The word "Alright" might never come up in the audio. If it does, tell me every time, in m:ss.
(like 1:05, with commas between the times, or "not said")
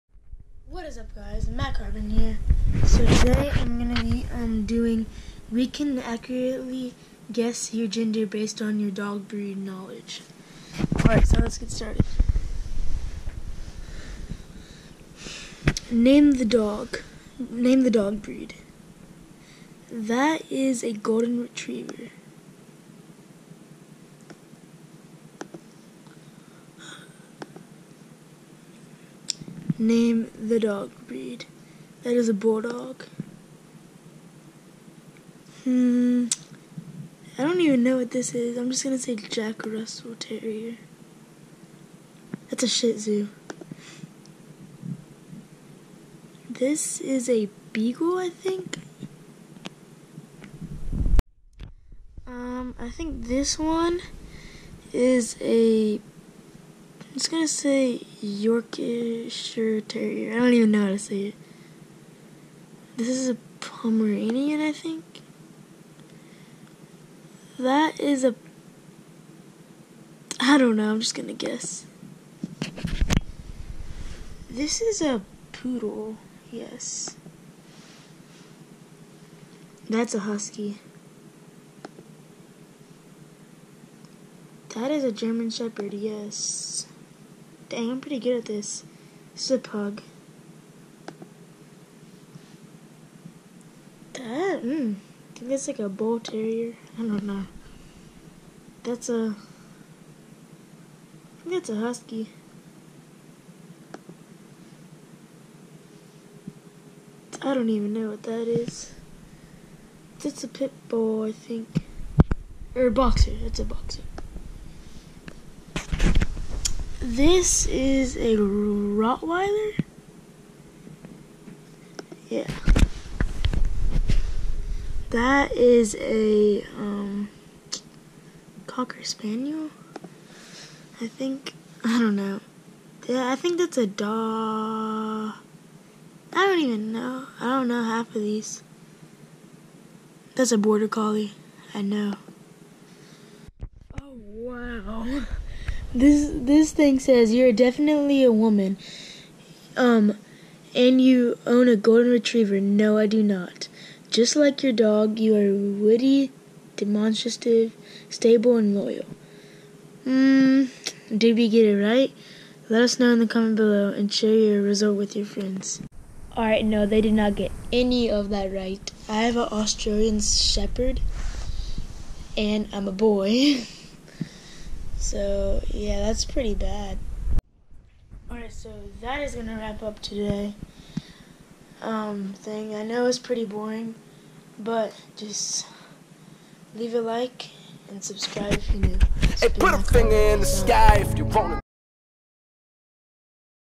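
0:10, 2:46, 2:58.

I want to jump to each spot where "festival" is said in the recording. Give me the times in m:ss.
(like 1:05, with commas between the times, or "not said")
not said.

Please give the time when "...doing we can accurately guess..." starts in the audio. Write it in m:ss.
0:04.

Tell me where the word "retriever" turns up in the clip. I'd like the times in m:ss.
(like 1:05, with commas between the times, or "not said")
0:21, 2:32.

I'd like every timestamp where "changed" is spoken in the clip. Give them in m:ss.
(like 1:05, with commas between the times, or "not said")
not said.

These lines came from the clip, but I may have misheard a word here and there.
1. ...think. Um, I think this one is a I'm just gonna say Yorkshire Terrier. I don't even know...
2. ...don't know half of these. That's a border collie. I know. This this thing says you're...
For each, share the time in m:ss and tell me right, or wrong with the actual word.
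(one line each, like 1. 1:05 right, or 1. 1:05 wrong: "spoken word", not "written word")
1. 0:48 right
2. 2:17 right.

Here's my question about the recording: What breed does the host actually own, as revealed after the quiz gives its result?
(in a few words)
Australian Shepherd.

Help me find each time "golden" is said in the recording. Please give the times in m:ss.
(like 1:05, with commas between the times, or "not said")
0:20, 2:31.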